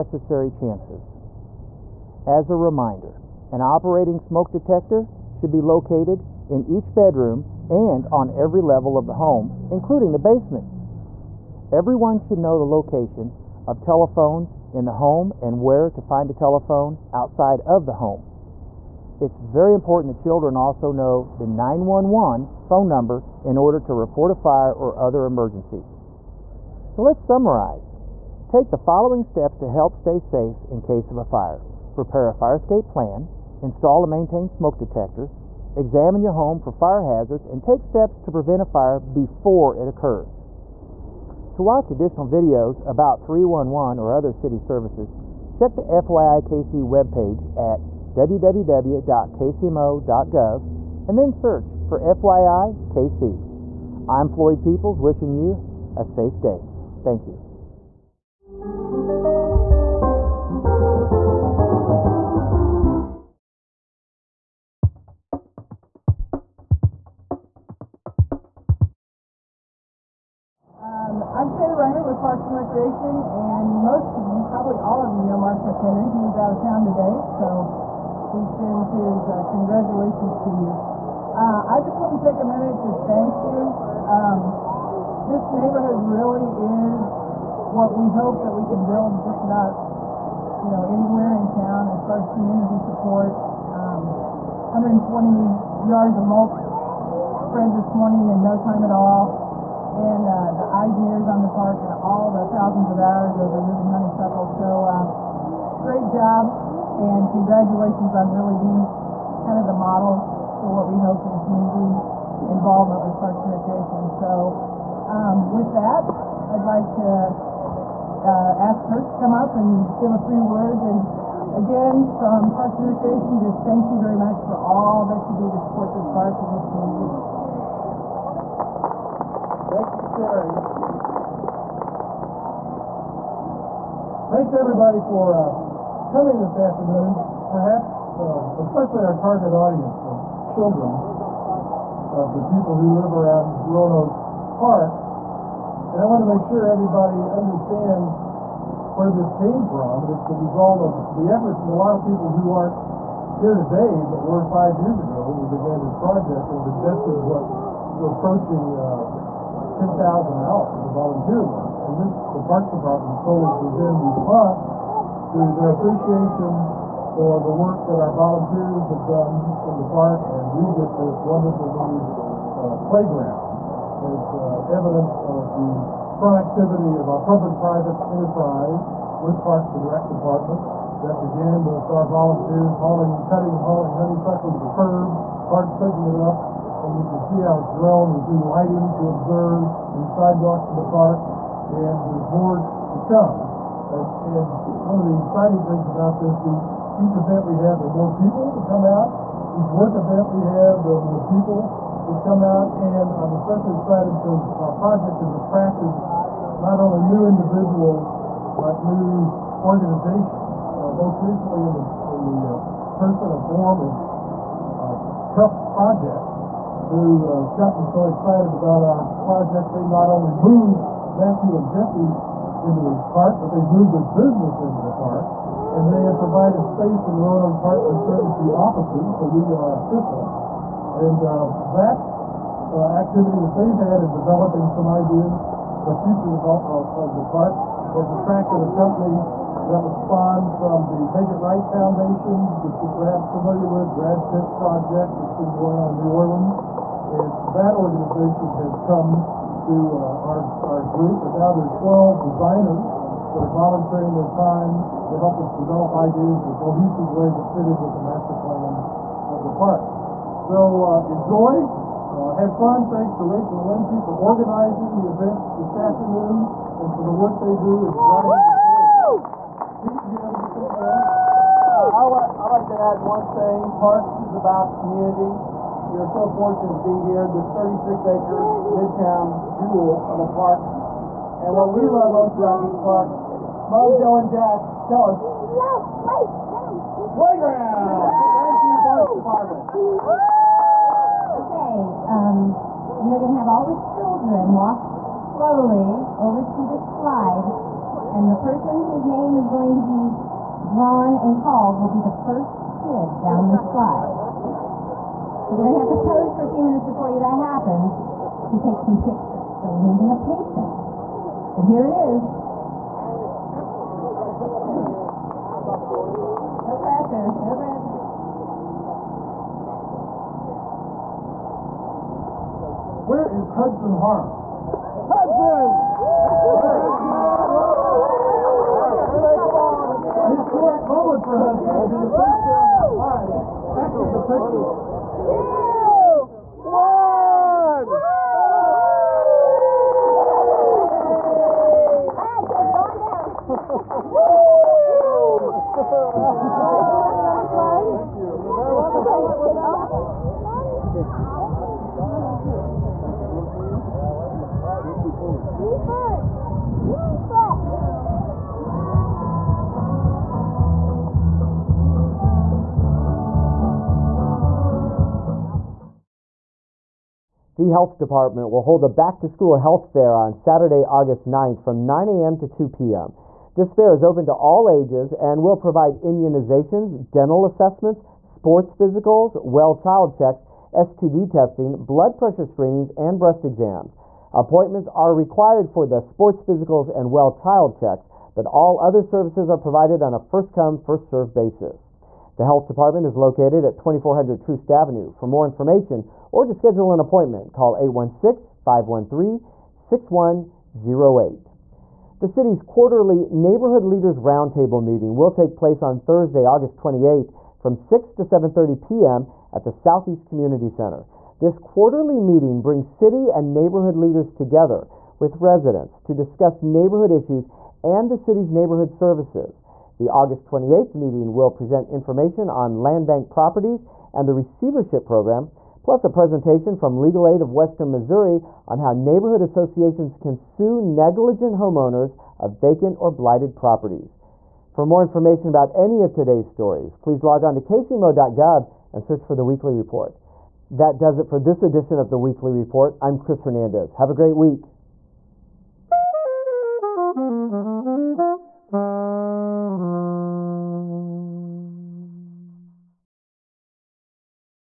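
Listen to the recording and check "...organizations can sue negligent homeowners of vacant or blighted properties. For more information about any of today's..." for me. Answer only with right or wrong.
wrong.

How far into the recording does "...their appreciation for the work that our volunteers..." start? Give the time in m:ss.
2:45.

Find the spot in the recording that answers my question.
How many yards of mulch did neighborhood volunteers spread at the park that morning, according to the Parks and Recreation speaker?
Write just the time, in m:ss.
1:34.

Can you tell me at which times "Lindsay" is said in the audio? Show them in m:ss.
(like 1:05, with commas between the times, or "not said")
4:23.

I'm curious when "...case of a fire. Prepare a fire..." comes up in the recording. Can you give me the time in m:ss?
0:30.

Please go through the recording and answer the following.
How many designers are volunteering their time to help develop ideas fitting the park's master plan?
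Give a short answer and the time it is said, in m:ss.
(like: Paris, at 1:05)
12, at 4:11.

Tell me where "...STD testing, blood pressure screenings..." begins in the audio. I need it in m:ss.
6:20.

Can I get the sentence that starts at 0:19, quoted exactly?
It's very important that children also know the 911 phone number in order to report a fire or other emergency.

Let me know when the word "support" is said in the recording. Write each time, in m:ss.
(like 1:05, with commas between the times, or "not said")
1:32, 2:05.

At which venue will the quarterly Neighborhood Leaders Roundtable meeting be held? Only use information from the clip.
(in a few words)
Southeast Community Center.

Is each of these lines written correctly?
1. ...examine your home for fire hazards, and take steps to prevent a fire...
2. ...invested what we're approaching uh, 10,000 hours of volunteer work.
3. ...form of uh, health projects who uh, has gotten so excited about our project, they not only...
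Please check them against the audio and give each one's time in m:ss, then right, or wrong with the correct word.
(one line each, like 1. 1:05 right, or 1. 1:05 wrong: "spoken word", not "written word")
1. 0:35 right
2. 2:36 right
3. 3:33 right.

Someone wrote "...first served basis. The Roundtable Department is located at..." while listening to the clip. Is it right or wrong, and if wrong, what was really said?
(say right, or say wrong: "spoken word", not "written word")
wrong: "Health", not "Roundtable".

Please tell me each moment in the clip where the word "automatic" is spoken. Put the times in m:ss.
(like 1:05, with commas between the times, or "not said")
not said.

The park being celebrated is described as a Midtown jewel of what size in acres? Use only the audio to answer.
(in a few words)
36.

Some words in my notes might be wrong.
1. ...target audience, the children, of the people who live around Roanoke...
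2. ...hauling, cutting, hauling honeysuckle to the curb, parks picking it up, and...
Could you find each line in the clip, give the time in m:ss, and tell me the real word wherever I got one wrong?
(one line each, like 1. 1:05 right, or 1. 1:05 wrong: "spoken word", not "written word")
1. 2:19 right
2. 3:02 right.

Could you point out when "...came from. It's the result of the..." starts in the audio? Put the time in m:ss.
2:29.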